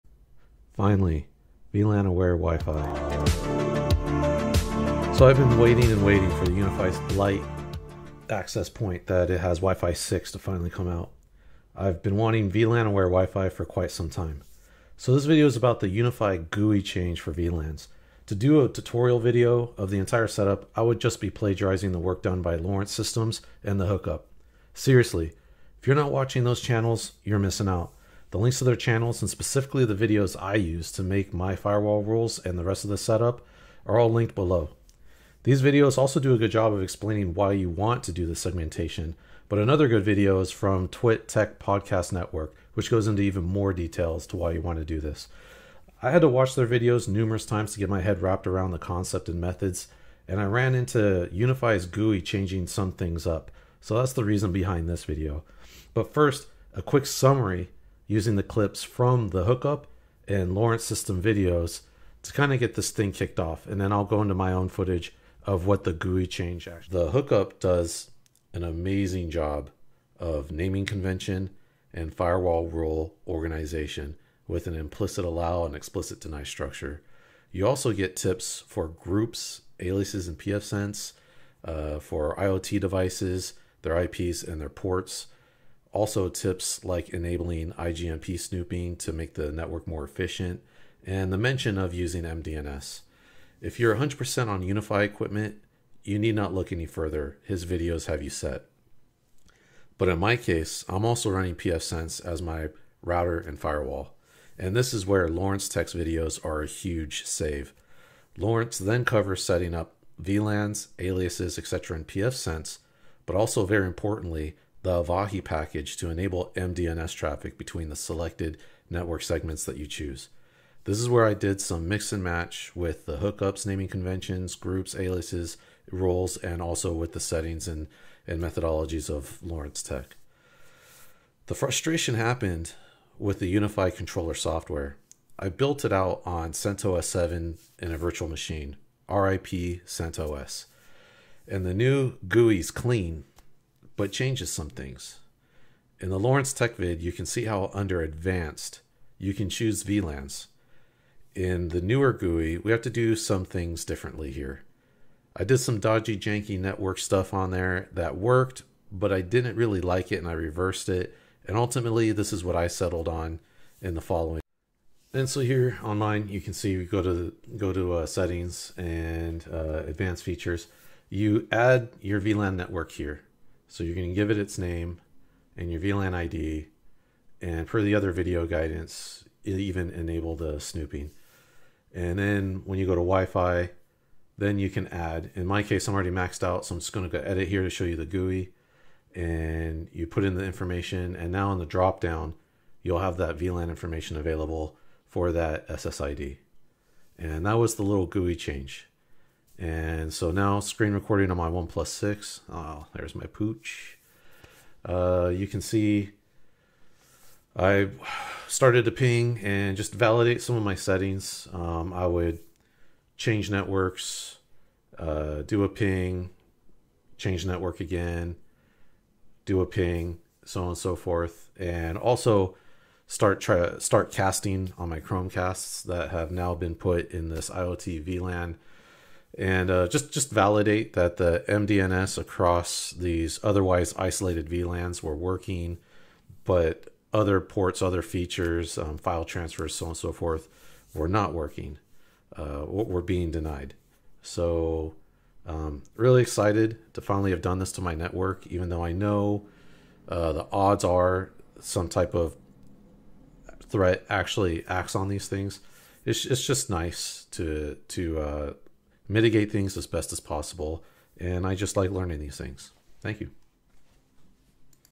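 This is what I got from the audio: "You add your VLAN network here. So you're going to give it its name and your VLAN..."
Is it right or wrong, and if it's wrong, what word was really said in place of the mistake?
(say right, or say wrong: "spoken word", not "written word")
right.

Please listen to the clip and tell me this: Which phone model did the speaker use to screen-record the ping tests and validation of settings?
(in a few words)
OnePlus 6.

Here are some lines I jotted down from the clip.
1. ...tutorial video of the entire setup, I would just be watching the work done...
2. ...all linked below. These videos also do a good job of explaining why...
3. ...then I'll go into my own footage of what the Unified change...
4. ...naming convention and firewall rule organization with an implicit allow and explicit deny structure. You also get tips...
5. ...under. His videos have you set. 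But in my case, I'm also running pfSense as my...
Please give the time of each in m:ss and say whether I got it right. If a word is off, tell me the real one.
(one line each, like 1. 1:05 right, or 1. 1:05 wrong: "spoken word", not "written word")
1. 0:18 wrong: "plagiarizing", not "watching"
2. 0:33 right
3. 1:03 wrong: "GUI", not "Unified"
4. 1:10 right
5. 1:36 wrong: "further", not "under".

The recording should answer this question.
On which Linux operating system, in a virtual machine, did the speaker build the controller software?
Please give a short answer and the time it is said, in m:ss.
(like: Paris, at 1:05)
CentOS 7, at 2:16.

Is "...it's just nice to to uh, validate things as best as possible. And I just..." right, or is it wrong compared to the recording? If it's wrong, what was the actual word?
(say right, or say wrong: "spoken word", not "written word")
wrong: "mitigate", not "validate".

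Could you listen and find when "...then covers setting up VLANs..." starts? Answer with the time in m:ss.
1:48.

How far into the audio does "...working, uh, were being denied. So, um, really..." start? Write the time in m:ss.
4:01.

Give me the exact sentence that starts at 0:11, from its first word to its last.
I've been wanting VLAN aware Wi Fi for quite some time.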